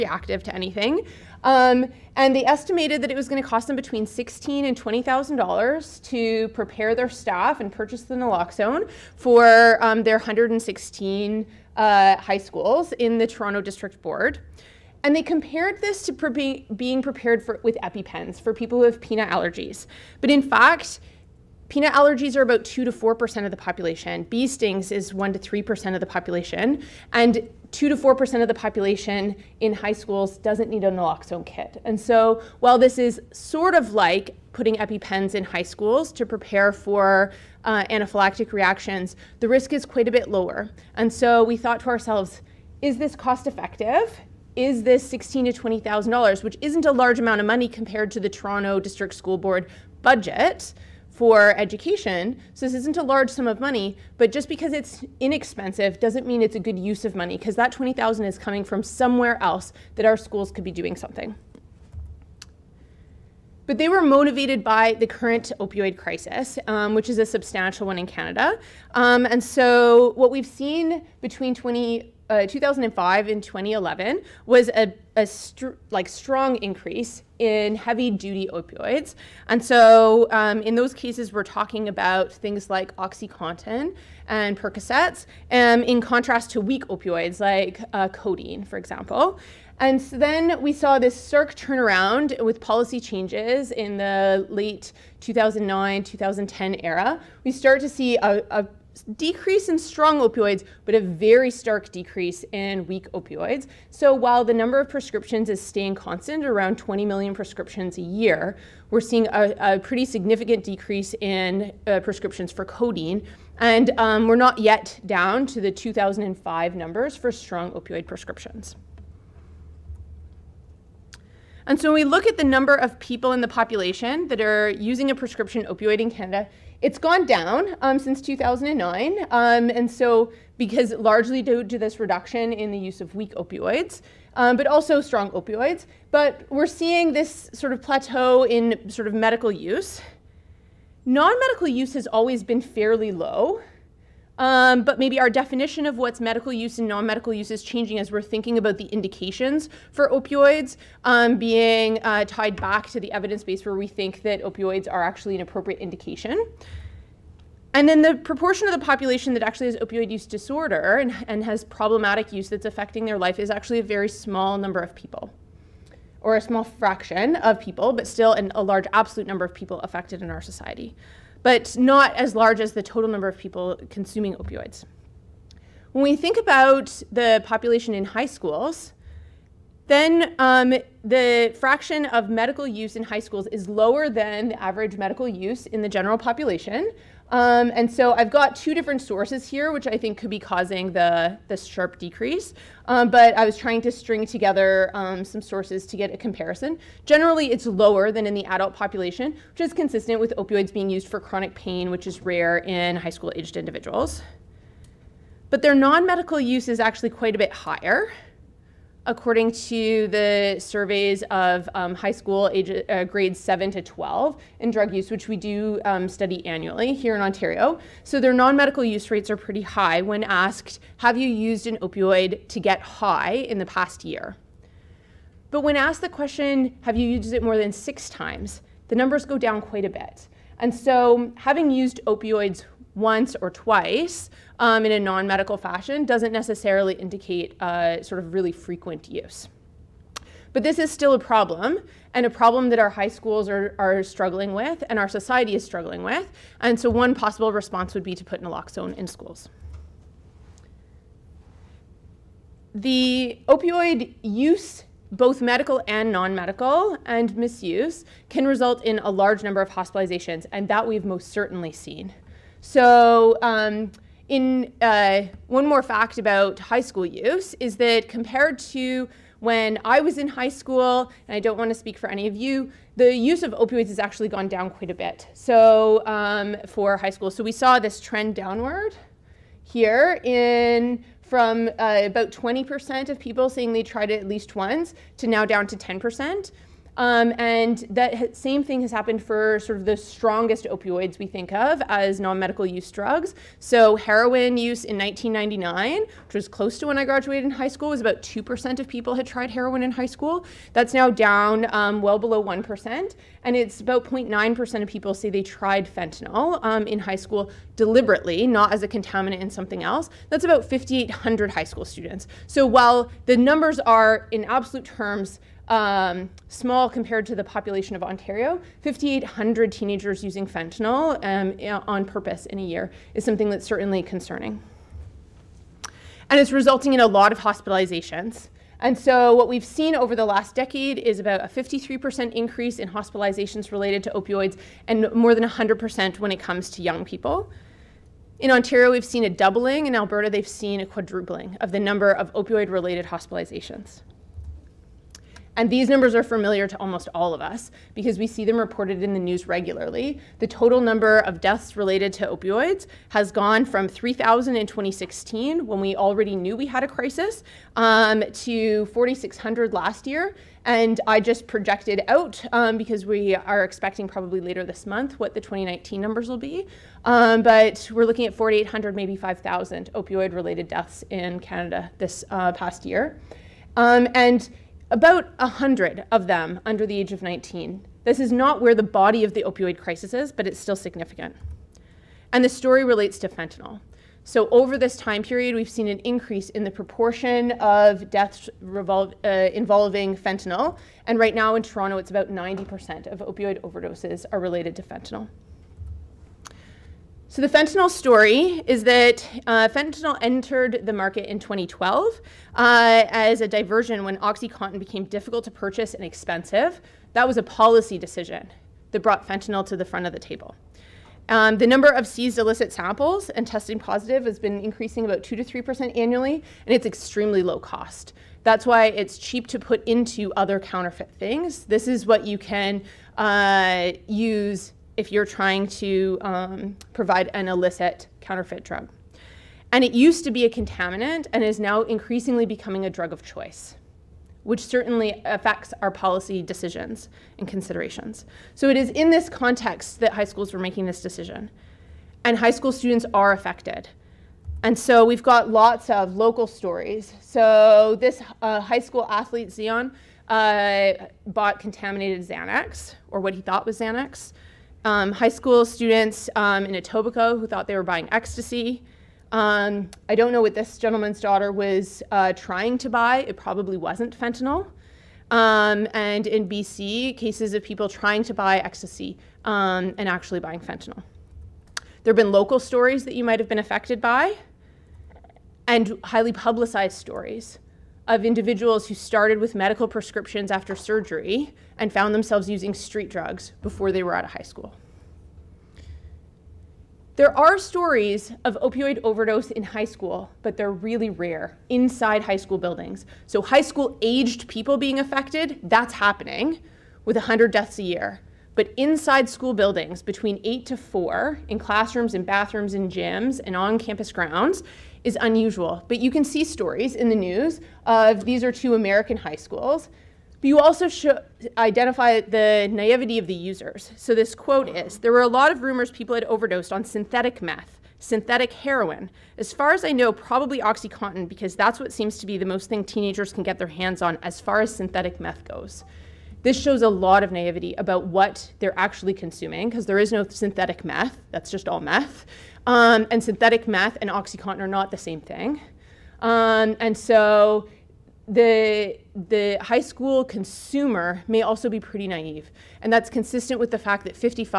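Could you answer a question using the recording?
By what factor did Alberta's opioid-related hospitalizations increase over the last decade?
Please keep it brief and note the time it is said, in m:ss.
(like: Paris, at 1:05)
quadrupling, at 5:40.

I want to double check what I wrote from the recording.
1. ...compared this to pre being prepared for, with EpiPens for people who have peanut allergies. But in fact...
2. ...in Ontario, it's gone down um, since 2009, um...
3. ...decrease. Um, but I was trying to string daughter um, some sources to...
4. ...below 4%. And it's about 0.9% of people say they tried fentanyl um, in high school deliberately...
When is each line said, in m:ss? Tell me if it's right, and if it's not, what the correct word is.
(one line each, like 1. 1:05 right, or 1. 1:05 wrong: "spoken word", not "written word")
1. 0:15 right
2. 2:06 wrong: "Canada", not "Ontario"
3. 3:11 wrong: "together", not "daughter"
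4. 5:02 wrong: "1", not "4".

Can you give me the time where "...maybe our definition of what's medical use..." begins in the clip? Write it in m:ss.
2:24.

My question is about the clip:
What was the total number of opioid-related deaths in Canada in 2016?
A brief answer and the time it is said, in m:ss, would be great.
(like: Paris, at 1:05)
3,000, at 5:53.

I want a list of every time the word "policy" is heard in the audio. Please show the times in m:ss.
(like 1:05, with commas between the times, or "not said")
1:32, 6:47, 7:15.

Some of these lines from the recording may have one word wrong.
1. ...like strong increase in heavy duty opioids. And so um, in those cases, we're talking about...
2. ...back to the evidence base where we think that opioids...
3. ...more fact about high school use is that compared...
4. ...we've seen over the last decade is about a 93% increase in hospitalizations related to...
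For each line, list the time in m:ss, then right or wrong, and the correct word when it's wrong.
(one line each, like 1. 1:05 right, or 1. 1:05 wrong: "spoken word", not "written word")
1. 1:15 right
2. 2:32 right
3. 4:25 right
4. 5:29 wrong: "53", not "93".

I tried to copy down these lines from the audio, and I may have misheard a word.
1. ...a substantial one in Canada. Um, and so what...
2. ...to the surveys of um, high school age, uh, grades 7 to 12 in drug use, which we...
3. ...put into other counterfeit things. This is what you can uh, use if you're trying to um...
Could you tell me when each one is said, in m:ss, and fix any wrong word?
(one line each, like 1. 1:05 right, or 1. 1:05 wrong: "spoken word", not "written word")
1. 1:07 right
2. 3:29 right
3. 6:59 right.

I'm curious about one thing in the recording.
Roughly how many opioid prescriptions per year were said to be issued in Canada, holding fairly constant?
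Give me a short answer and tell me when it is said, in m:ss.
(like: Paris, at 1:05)
20 million, at 1:46.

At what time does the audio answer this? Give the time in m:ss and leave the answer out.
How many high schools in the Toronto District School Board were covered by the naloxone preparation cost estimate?
0:10.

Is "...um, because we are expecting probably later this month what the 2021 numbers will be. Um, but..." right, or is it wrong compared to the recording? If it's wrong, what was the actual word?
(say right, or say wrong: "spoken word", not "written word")
wrong: "2019", not "2021".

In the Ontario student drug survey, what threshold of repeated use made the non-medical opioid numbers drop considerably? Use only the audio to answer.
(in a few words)
more than six times.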